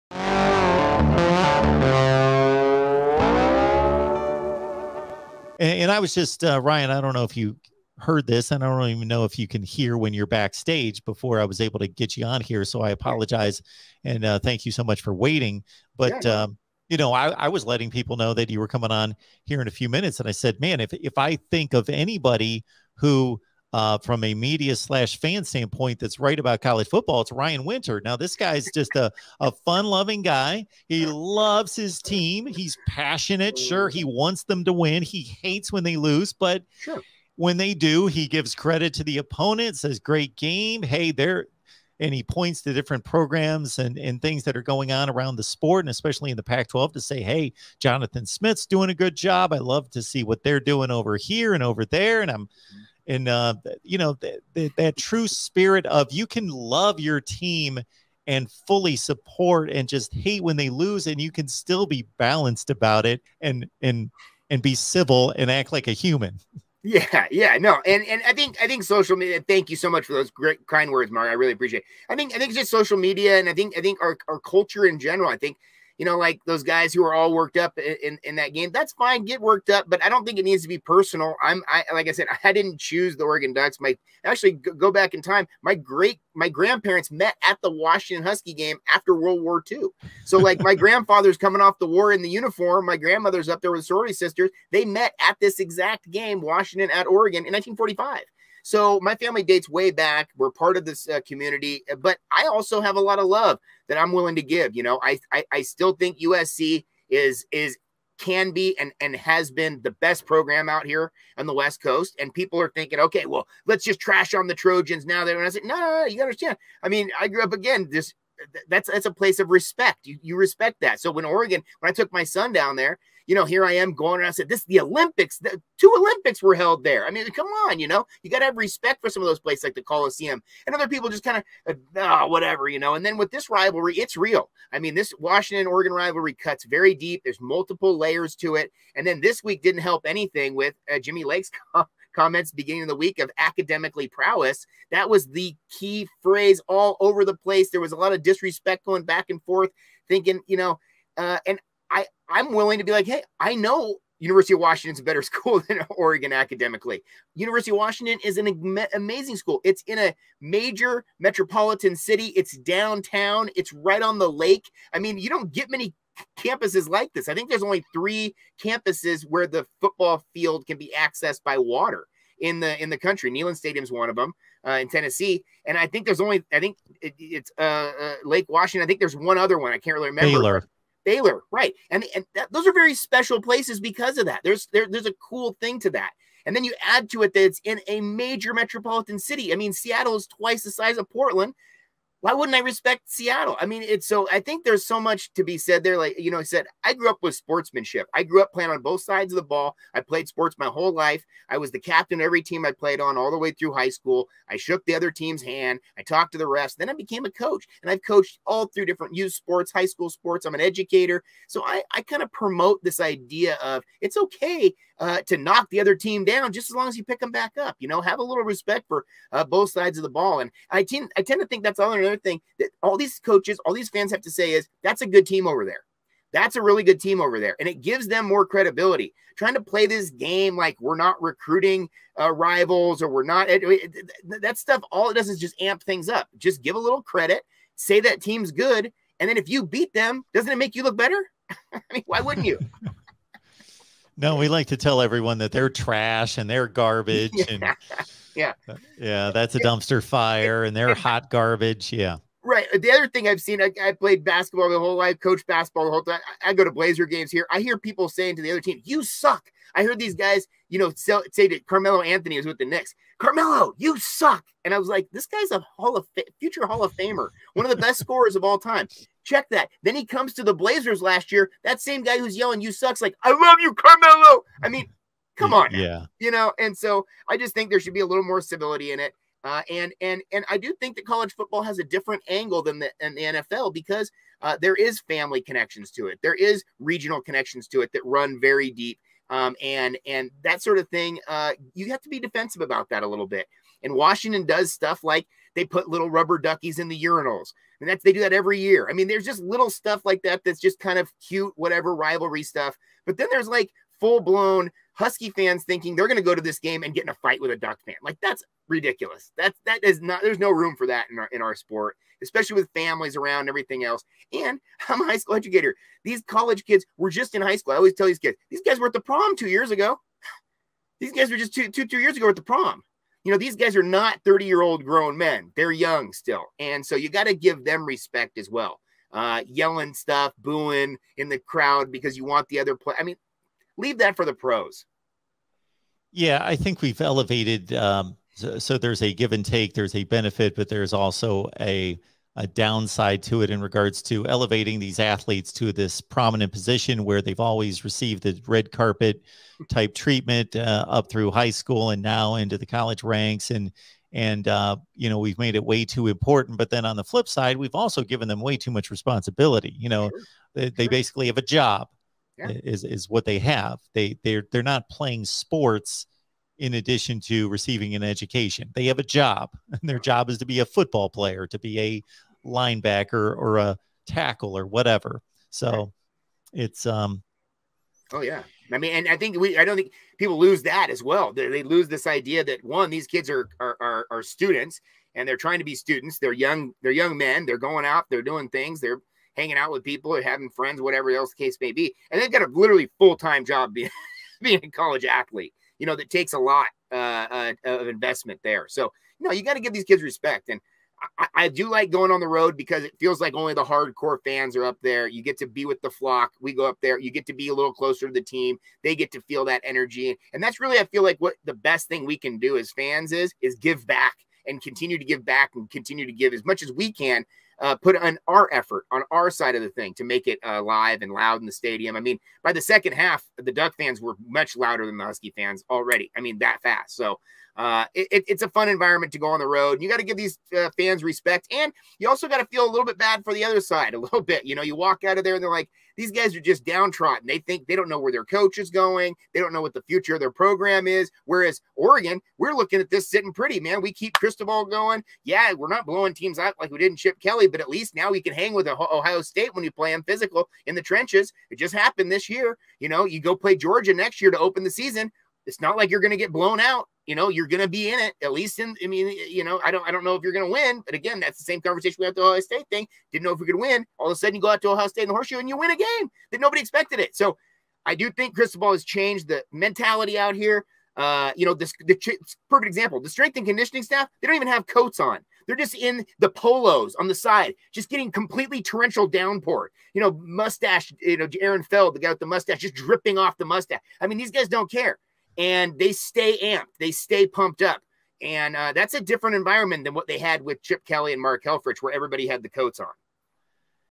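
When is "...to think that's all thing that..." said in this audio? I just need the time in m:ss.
3:41.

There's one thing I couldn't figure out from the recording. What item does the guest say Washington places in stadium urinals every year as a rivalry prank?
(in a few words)
rubber duckies.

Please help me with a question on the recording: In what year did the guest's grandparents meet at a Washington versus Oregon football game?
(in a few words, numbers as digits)
1945.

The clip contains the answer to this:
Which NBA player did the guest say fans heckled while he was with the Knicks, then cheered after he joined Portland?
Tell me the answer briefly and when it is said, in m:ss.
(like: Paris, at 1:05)
Carmelo Anthony, at 4:21.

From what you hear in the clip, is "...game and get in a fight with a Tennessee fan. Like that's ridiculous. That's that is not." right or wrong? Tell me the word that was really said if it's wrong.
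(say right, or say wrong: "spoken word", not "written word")
wrong: "Duck", not "Tennessee".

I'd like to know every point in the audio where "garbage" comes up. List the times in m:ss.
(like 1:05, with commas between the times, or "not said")
4:06, 4:11.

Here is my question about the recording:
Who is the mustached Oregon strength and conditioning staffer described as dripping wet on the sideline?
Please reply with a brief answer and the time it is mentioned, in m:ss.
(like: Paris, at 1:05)
Aaron Feld, at 8:01.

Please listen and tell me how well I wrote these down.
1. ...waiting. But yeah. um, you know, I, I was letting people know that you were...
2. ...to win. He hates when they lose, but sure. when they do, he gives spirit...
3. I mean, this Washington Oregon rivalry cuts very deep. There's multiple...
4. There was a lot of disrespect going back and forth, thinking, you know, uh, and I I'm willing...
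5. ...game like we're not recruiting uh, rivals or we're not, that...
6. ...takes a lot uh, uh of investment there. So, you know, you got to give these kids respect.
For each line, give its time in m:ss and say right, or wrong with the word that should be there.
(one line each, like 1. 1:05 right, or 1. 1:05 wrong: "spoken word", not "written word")
1. 0:15 right
2. 0:34 wrong: "credit", not "spirit"
3. 2:14 right
4. 2:27 right
5. 3:50 right
6. 6:36 right.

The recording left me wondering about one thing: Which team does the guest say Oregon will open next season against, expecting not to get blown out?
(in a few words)
Georgia.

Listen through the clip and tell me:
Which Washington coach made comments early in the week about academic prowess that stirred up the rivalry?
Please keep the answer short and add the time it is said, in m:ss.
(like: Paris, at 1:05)
Jimmy Lake, at 2:20.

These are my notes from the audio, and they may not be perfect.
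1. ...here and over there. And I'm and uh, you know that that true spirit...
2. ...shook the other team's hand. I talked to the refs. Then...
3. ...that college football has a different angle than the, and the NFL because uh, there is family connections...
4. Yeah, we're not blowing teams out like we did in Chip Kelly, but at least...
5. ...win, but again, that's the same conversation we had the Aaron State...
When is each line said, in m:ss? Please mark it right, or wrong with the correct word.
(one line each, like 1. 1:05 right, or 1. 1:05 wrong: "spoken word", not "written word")
1. 0:51 right
2. 3:24 right
3. 4:40 right
4. 7:25 right
5. 7:40 wrong: "Ohio", not "Aaron".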